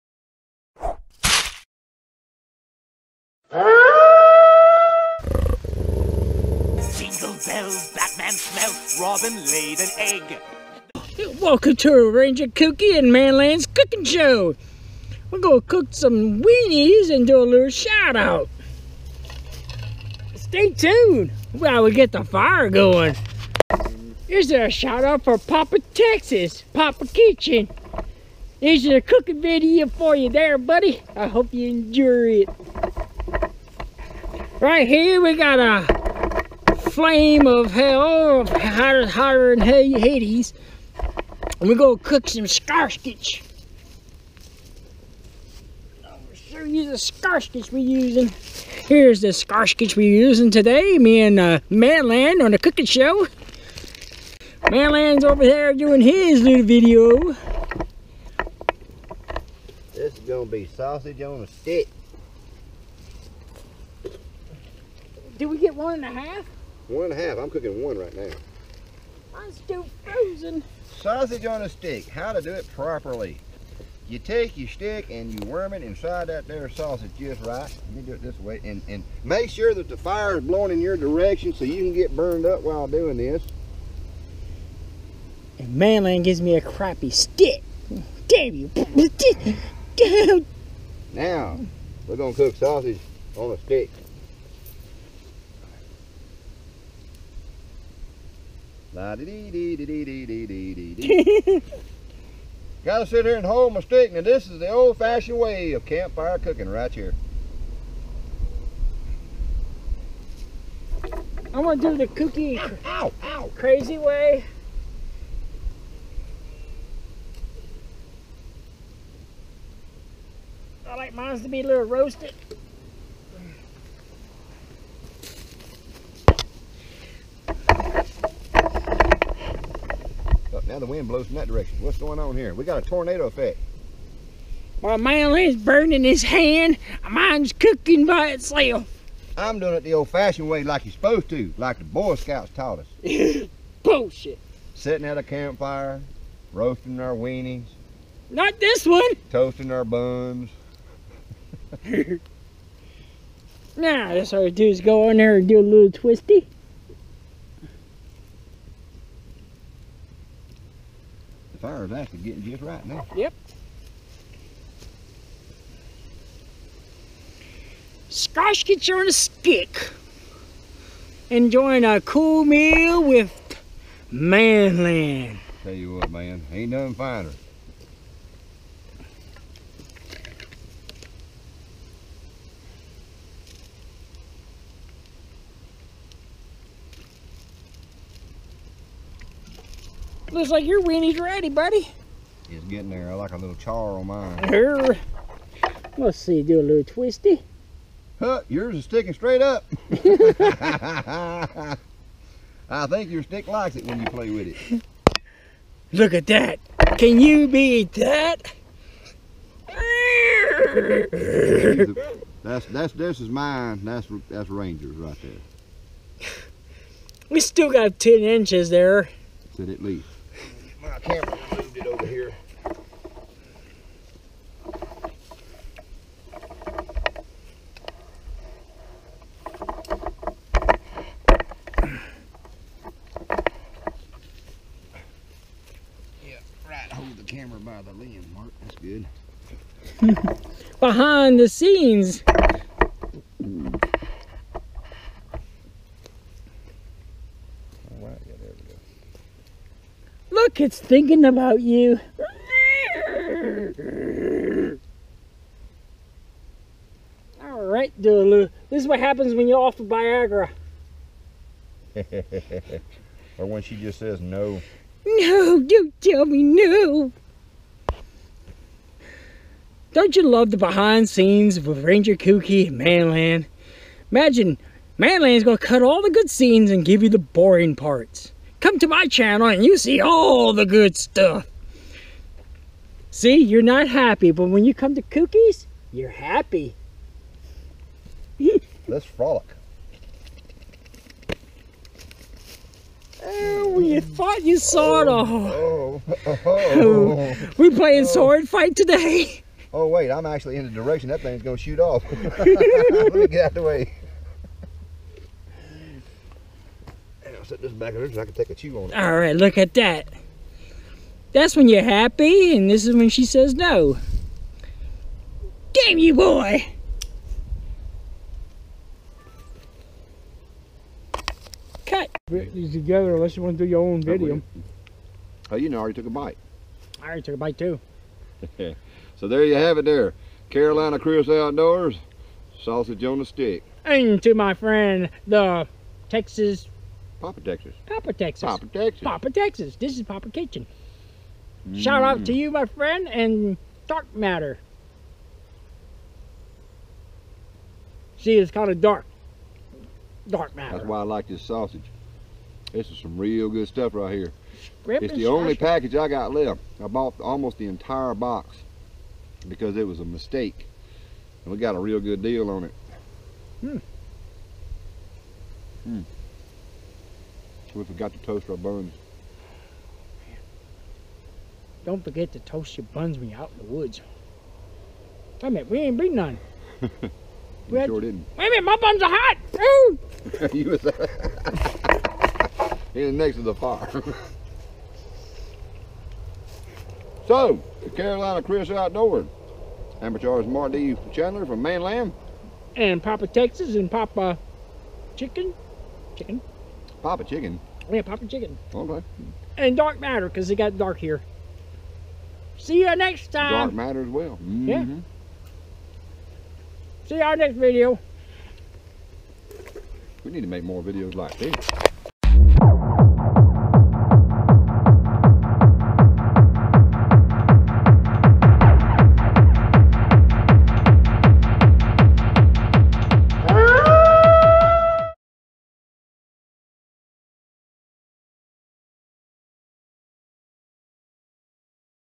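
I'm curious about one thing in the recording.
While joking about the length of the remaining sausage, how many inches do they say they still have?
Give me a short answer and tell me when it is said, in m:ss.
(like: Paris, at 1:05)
10, at 3:37.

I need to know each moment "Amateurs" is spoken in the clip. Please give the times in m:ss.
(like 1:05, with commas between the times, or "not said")
6:30.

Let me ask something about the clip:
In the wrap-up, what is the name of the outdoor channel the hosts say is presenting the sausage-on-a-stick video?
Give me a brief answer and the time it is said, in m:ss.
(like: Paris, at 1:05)
Carolina Cruise Outdoors, at 5:30.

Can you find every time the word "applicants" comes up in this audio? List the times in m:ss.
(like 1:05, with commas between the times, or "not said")
not said.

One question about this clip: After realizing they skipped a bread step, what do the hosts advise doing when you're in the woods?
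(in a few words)
Toast your buns.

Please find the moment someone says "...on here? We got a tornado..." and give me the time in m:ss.
2:12.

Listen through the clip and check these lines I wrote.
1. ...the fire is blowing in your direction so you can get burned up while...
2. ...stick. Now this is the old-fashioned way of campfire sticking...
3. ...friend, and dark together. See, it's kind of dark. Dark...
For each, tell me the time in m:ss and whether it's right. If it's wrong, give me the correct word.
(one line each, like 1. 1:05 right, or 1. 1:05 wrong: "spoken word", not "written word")
1. 1:19 right
2. 1:43 wrong: "cooking", not "sticking"
3. 5:42 wrong: "matter", not "together".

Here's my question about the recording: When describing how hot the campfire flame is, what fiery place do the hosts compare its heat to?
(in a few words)
Hades.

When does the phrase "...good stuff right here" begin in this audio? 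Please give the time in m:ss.
5:53.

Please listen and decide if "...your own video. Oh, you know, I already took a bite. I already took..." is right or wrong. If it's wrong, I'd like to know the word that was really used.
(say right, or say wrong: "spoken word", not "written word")
right.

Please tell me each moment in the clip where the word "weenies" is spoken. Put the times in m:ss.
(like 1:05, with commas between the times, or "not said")
0:16, 2:27, 3:10.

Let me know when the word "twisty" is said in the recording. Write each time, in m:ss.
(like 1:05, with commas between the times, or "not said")
2:35, 3:16.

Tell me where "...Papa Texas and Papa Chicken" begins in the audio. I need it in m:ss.
6:33.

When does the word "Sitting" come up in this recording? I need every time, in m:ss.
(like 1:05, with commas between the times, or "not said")
2:24.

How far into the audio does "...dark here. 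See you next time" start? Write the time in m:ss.
6:40.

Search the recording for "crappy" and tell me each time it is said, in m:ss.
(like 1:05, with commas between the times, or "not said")
1:26.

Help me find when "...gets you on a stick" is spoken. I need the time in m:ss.
2:48.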